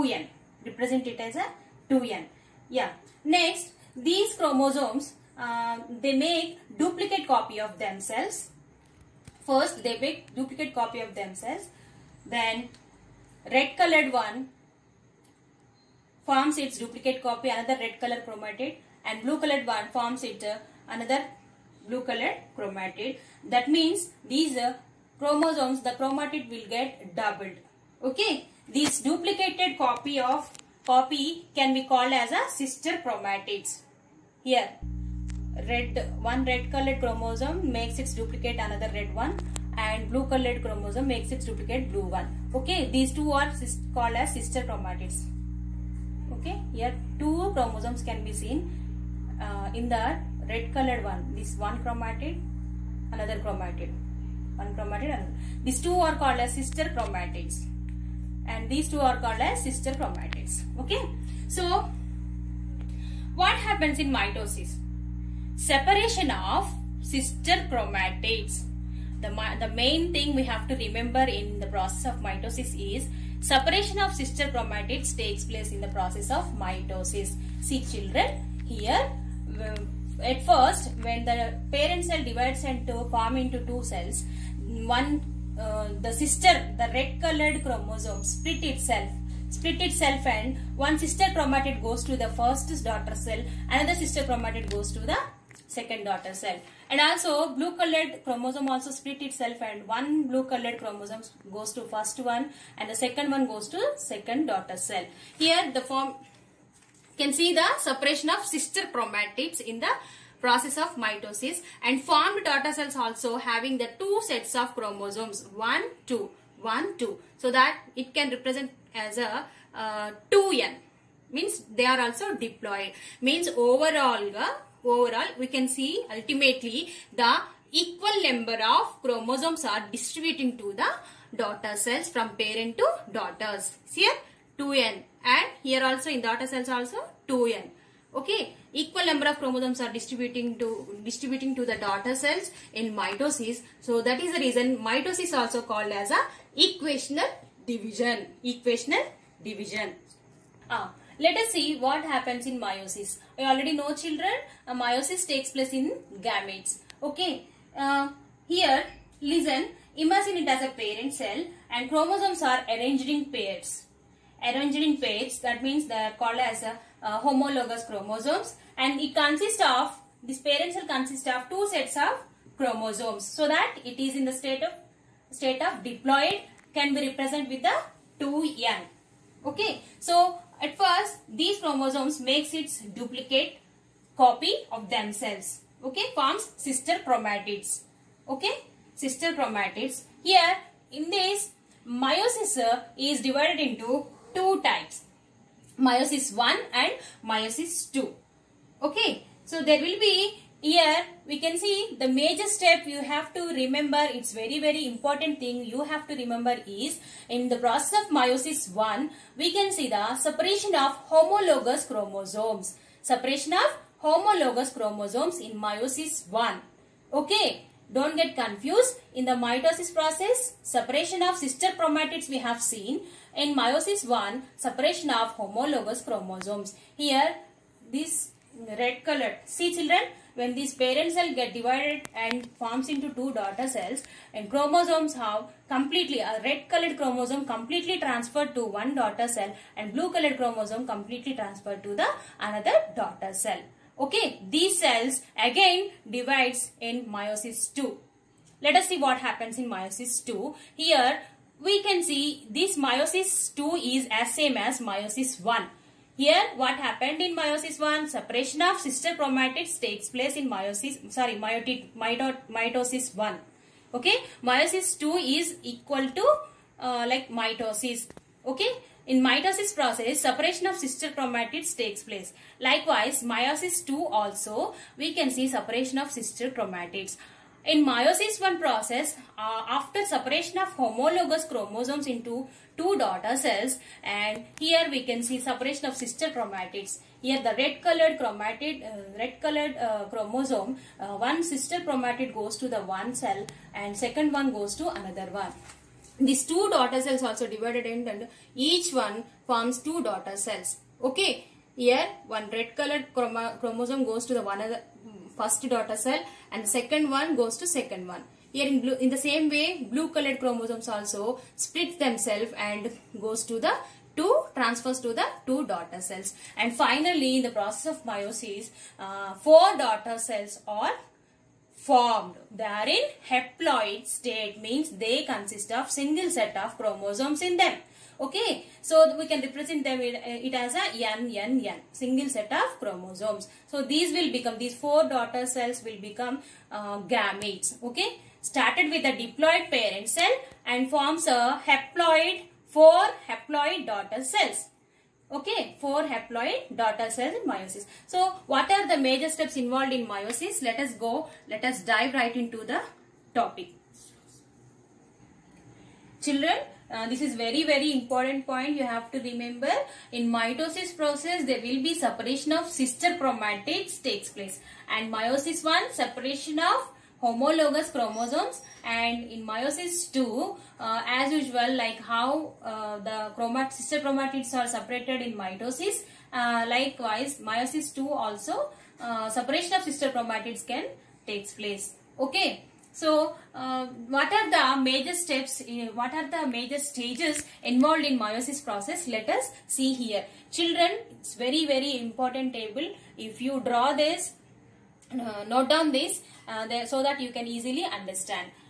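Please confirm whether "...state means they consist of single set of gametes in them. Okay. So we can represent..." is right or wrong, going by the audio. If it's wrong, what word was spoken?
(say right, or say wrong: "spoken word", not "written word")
wrong: "chromosomes", not "gametes".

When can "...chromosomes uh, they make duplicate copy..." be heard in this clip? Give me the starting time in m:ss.
0:04.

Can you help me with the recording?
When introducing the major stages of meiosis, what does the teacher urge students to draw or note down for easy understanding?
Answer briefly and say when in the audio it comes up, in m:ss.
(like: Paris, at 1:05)
table, at 6:32.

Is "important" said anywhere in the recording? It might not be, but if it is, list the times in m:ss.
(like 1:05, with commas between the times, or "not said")
3:24, 5:57, 6:32.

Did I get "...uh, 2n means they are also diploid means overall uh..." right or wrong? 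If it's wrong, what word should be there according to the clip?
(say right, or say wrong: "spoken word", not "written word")
right.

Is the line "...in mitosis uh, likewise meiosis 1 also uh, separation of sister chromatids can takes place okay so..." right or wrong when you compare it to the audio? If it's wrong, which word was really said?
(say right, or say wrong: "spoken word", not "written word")
wrong: "2", not "1".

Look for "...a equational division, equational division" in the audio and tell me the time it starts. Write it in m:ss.
2:26.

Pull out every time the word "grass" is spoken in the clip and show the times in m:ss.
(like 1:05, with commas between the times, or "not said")
not said.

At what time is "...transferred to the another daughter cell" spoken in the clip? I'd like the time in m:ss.
4:01.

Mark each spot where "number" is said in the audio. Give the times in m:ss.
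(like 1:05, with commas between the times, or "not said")
2:08, 2:19.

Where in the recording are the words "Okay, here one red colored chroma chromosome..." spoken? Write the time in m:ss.
5:01.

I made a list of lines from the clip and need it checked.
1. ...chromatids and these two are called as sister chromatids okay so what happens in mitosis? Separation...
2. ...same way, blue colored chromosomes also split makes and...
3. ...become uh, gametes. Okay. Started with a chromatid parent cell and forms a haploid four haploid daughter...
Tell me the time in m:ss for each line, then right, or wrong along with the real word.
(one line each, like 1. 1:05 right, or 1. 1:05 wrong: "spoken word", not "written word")
1. 0:56 right
2. 5:09 wrong: "themselves", not "makes"
3. 5:36 wrong: "diploid", not "chromatid".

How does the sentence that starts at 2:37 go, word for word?
Okay, uh, here listen, imagine it as a parent cell and chromosomes are arranged in pairs.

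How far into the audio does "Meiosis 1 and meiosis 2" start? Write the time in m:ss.
3:15.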